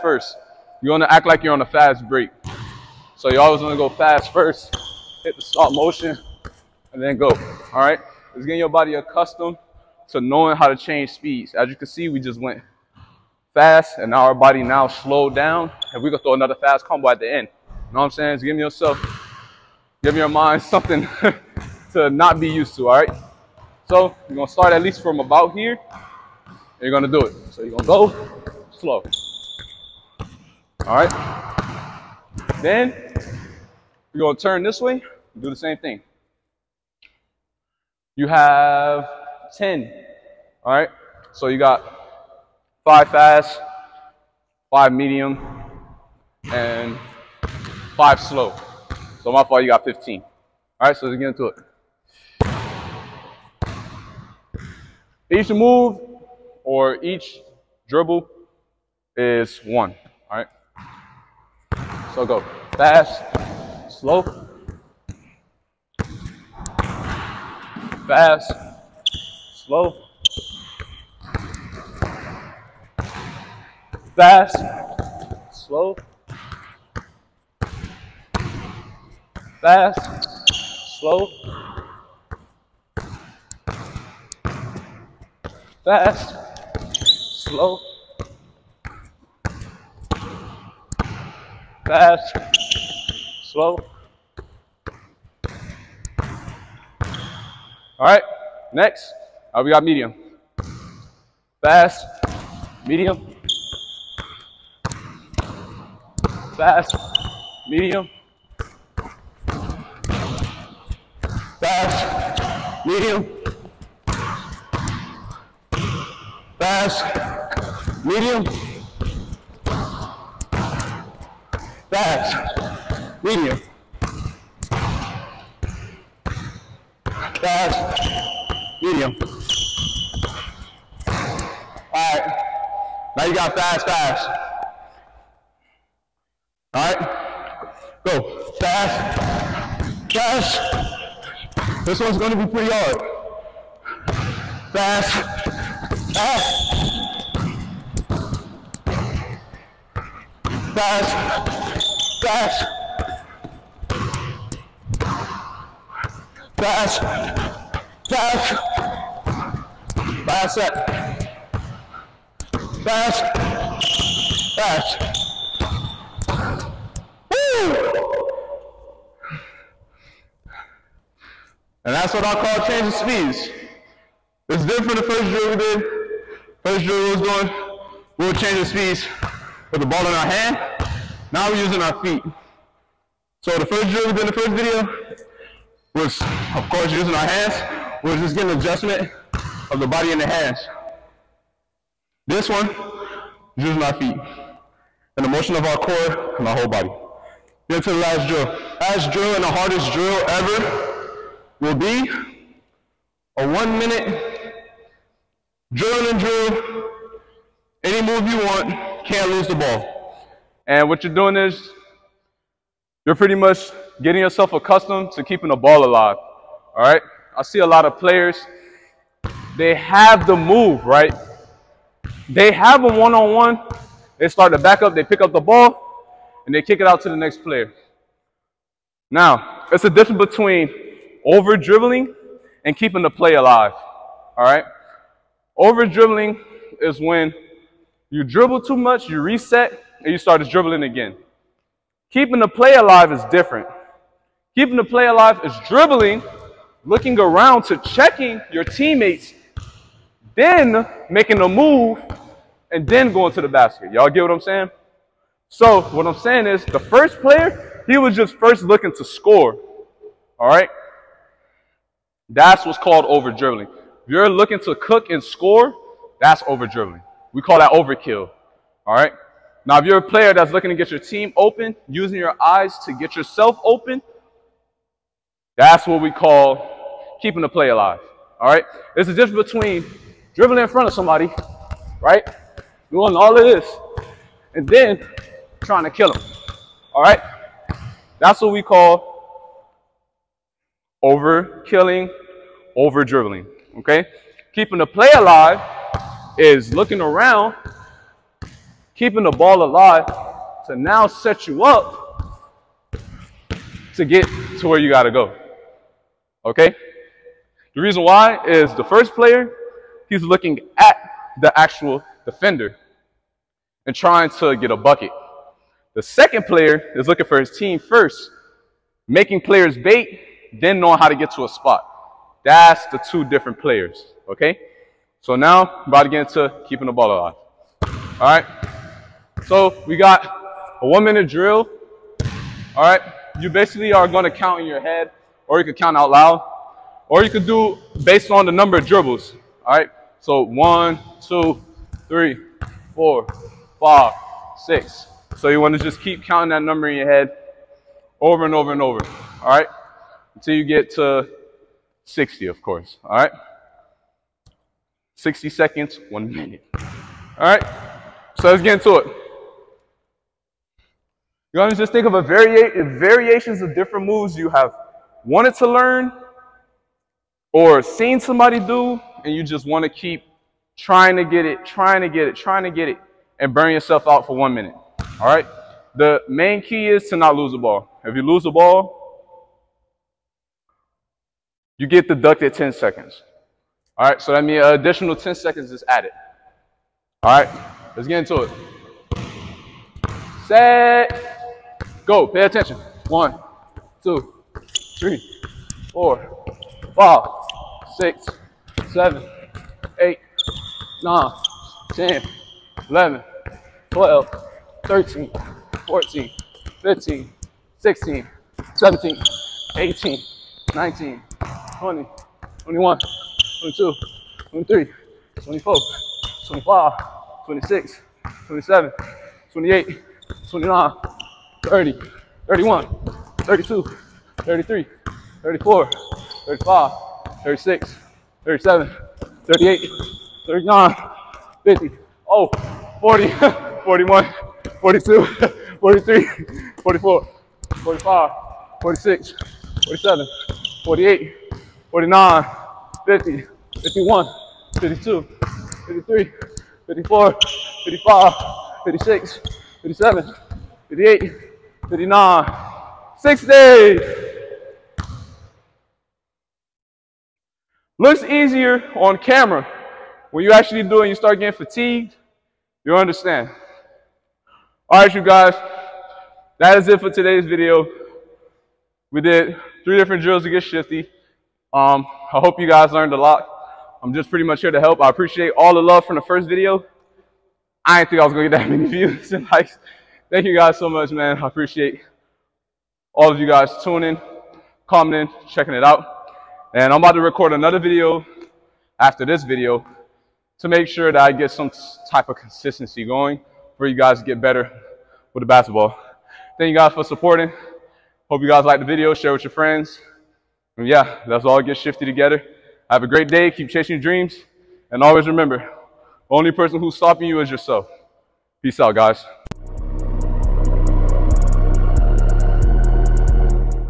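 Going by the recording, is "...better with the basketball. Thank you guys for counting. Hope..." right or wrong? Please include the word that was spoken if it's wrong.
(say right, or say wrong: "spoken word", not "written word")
wrong: "supporting", not "counting".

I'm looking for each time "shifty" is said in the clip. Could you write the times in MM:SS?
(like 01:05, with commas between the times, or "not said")
07:50, 08:21.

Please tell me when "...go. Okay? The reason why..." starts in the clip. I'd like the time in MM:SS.
05:05.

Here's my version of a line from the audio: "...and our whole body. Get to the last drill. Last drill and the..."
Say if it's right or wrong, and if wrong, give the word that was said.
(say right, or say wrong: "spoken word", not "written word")
right.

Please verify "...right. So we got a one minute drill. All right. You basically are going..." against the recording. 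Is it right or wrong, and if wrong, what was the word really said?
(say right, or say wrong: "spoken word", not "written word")
right.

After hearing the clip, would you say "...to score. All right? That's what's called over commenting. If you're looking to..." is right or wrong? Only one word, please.
wrong.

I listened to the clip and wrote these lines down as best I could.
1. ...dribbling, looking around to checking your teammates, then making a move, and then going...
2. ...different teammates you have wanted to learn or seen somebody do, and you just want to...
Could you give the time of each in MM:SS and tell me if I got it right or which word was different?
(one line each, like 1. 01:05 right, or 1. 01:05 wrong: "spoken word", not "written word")
1. 04:05 right
2. 06:03 wrong: "moves", not "teammates".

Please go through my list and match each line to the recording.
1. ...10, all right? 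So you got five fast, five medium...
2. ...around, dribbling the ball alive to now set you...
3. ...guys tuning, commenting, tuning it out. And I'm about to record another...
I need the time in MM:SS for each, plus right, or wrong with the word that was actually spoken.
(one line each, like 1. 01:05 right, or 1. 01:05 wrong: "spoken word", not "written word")
1. 00:39 right
2. 04:57 wrong: "keeping", not "dribbling"
3. 08:03 wrong: "checking", not "tuning".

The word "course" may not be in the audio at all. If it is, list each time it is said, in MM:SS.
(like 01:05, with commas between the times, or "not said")
03:06, 05:52.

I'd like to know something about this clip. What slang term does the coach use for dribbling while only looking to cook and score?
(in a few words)
overkill.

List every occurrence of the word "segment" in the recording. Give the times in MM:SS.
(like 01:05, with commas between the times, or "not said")
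not said.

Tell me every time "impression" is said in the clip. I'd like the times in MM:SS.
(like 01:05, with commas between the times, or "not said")
not said.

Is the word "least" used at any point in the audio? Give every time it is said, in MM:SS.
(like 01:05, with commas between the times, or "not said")
00:24.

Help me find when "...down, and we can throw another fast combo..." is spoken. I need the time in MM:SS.
00:15.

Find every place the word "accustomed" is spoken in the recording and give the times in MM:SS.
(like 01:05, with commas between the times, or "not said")
00:08, 03:34.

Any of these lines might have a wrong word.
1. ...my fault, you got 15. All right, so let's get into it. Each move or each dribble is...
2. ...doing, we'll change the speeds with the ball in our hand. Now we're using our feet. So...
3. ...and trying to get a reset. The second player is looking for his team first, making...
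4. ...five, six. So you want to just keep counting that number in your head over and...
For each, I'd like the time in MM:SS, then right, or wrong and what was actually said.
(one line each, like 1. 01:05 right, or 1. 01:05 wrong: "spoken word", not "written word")
1. 00:49 right
2. 02:57 right
3. 05:13 wrong: "bucket", not "reset"
4. 05:43 right.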